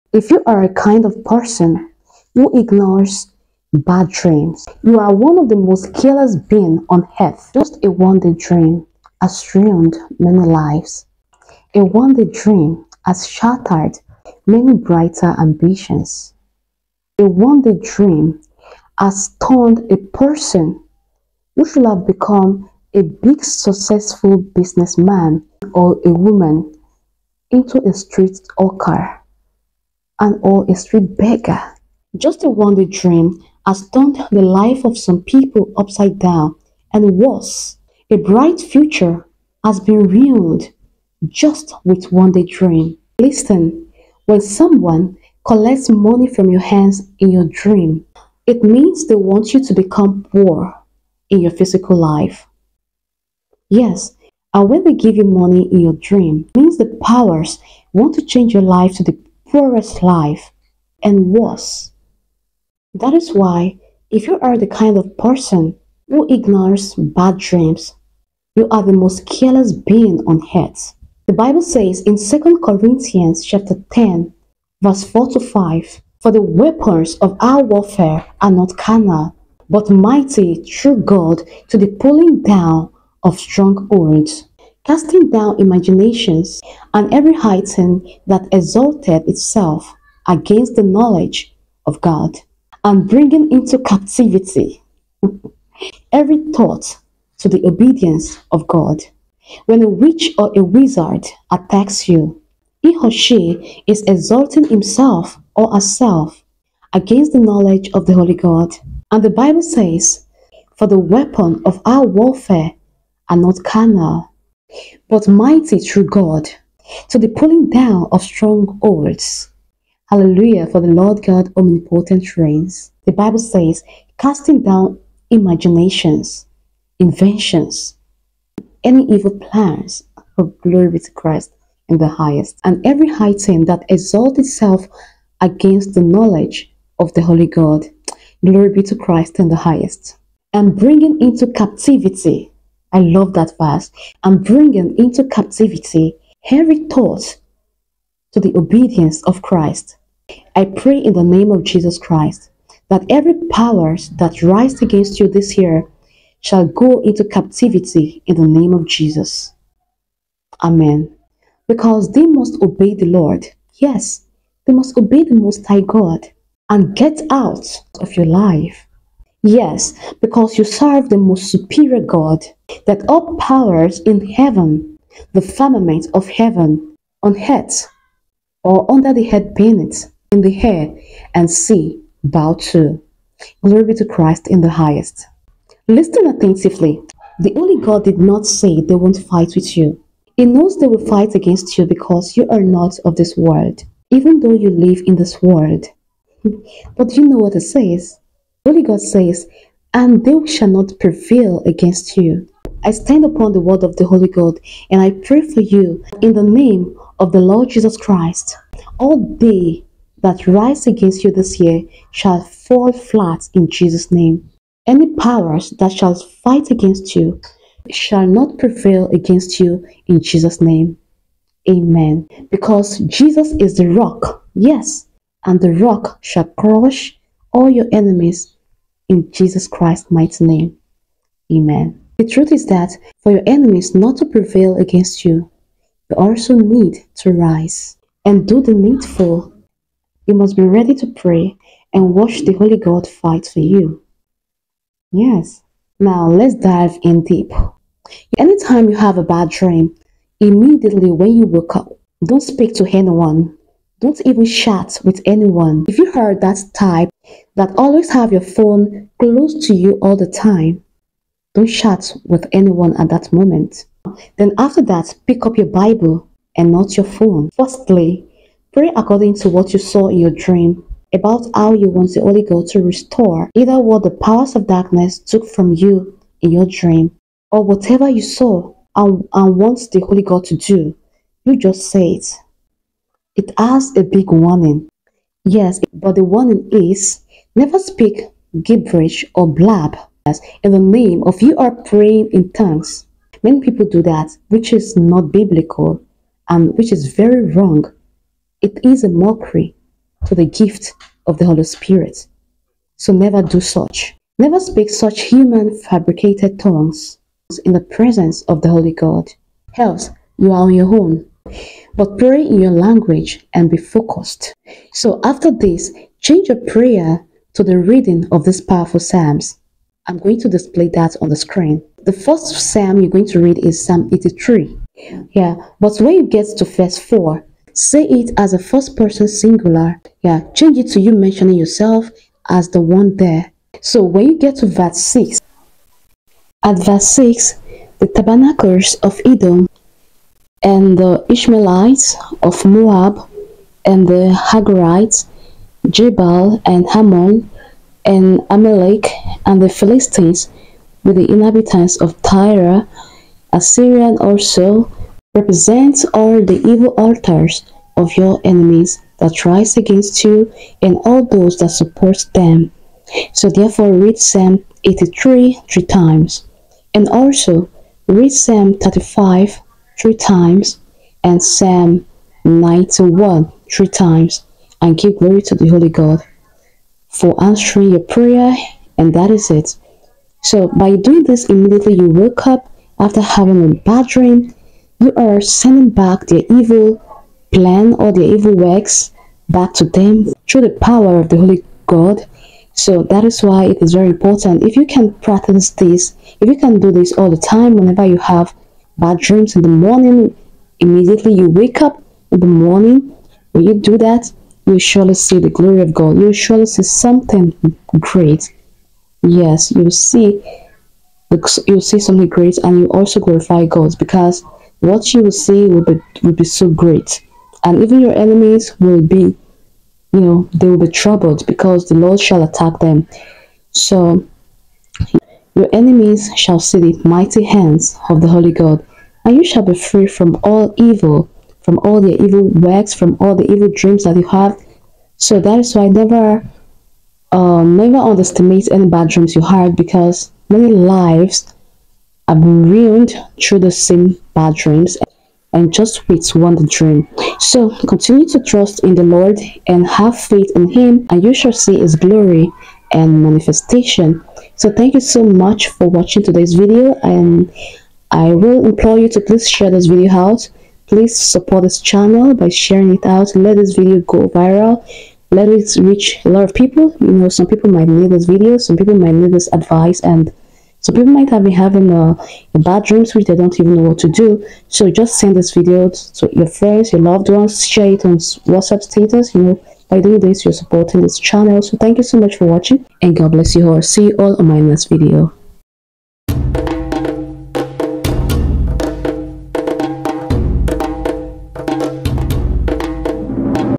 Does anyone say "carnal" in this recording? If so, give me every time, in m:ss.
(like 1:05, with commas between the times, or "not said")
1:18, 1:53.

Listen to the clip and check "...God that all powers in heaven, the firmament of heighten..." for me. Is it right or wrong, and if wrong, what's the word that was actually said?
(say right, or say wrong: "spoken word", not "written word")
wrong: "heaven", not "heighten".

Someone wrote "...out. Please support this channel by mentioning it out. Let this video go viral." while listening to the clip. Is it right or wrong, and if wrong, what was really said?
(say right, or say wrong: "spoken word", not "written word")
wrong: "sharing", not "mentioning".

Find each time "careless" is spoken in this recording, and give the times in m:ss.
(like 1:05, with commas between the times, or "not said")
0:05, 1:09.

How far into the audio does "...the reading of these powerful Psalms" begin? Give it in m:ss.
5:17.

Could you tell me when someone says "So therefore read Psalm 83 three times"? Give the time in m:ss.
6:03.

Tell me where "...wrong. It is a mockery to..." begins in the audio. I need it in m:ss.
4:57.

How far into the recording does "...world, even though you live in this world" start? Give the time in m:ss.
3:13.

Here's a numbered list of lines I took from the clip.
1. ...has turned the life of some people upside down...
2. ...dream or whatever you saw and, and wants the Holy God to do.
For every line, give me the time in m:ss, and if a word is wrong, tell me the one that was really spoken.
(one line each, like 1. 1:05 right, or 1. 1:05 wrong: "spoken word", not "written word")
1. 0:33 right
2. 4:36 right.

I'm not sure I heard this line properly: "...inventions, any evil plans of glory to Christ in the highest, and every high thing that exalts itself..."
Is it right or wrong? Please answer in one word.
right.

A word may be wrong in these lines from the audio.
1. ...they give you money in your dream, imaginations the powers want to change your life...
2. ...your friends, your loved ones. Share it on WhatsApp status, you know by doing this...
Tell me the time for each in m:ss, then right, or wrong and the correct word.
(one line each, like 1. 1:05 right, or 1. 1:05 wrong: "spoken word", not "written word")
1. 0:54 wrong: "means", not "imaginations"
2. 7:56 right.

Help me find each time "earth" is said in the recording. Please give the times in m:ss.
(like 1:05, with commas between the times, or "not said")
0:07, 1:10.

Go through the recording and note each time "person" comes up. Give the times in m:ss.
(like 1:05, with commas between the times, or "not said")
0:01, 0:19, 1:05, 5:28.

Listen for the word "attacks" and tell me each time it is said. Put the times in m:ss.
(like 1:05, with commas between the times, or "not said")
1:41, 7:02.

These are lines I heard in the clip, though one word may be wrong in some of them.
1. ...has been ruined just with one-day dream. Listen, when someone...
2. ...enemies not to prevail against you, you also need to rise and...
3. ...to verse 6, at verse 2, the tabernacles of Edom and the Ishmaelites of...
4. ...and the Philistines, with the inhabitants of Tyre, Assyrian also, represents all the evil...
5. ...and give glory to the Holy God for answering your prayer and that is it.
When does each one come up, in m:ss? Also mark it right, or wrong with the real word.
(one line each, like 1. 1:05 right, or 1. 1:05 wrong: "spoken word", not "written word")
1. 0:39 right
2. 3:53 right
3. 5:34 wrong: "6", not "2"
4. 5:49 right
5. 6:14 right.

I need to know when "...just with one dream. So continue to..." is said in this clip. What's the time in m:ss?
7:25.